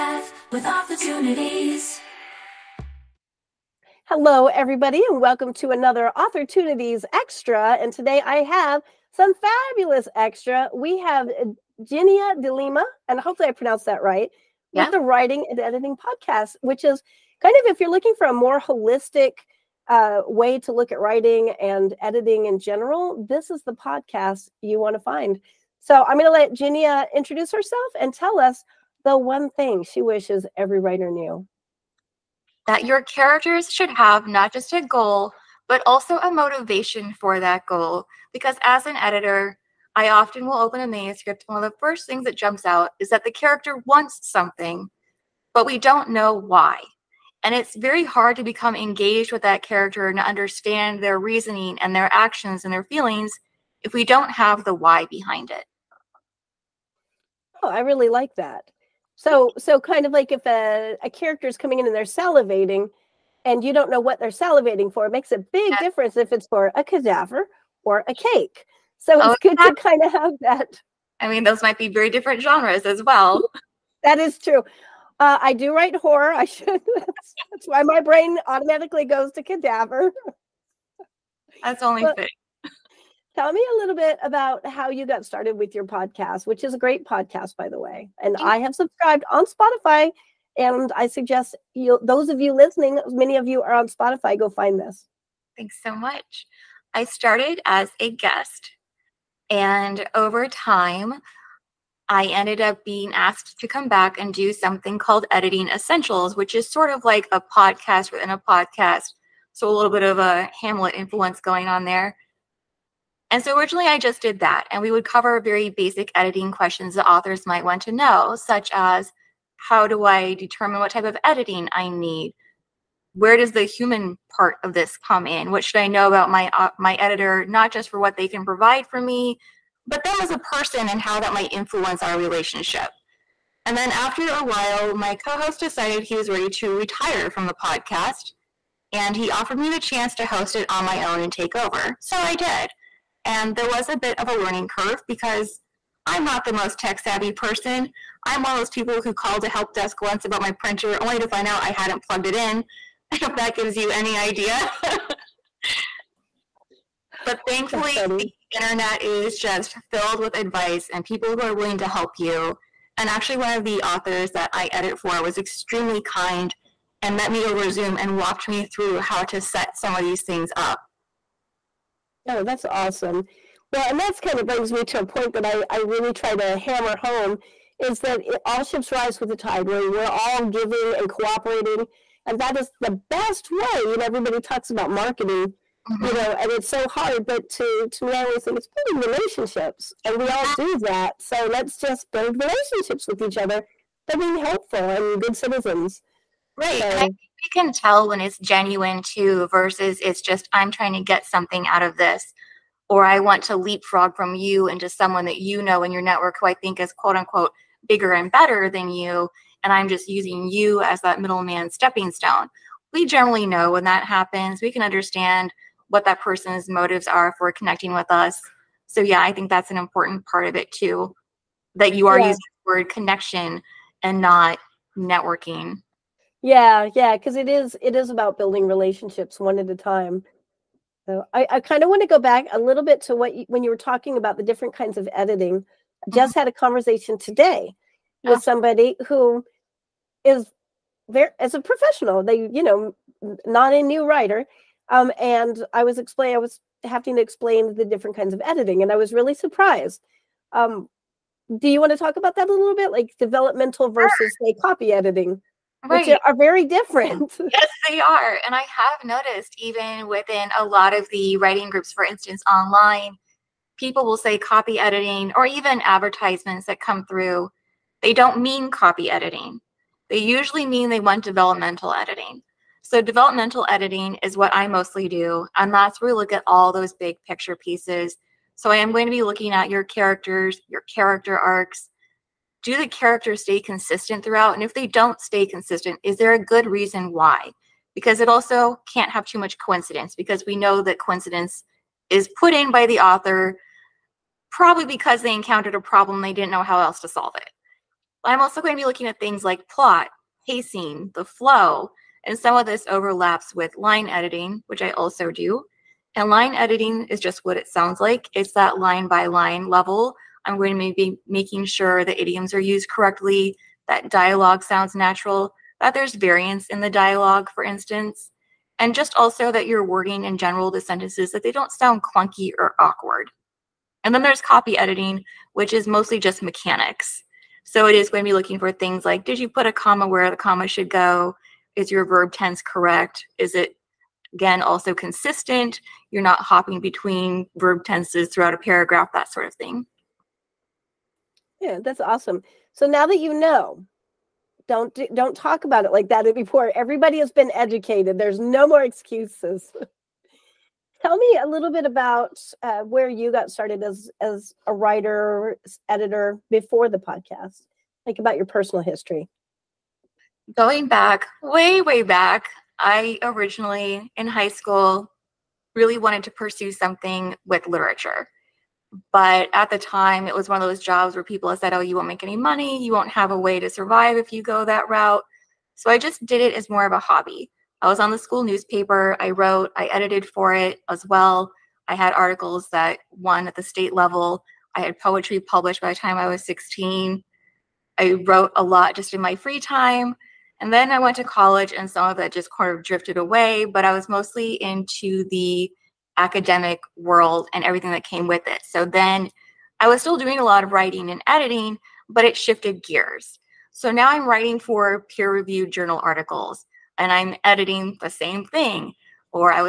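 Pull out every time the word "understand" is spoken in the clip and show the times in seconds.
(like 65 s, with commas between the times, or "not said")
50 s, 214 s.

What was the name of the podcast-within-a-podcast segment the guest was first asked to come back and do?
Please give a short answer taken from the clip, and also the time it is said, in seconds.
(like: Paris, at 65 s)
Editing Essentials, at 105 s.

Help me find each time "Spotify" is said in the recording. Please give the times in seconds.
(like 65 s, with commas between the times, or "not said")
89 s, 93 s.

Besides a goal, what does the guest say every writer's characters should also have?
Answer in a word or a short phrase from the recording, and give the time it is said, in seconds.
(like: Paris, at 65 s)
A motivation, at 36 s.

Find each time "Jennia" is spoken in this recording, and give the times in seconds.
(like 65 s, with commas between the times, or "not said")
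11 s, 26 s.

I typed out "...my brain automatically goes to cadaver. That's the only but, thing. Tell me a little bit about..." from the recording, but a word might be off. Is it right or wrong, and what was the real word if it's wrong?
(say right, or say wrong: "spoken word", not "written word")
right.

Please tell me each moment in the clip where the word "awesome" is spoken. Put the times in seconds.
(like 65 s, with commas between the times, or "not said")
172 s, 342 s.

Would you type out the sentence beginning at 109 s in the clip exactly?
So a little bit of a Hamlet influence going on there.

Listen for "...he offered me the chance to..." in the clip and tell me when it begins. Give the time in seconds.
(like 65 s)
139 s.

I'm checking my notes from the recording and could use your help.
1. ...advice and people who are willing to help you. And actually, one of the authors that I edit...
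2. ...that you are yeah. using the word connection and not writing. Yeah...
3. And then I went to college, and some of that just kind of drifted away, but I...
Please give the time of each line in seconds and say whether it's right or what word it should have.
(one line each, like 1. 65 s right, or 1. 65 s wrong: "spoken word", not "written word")
1. 160 s right
2. 221 s wrong: "networking", not "writing"
3. 390 s right.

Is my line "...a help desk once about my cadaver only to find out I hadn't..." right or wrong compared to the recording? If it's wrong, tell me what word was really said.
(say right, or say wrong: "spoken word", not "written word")
wrong: "printer", not "cadaver".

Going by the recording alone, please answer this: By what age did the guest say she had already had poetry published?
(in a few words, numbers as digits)
16.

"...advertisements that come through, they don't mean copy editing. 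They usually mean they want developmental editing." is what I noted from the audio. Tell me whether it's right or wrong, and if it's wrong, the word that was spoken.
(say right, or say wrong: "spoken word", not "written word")
right.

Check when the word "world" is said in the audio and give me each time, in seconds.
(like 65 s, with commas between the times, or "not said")
396 s.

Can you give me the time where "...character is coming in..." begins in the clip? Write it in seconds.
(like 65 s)
61 s.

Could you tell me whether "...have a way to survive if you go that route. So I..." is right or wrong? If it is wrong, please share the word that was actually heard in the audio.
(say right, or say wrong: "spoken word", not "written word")
right.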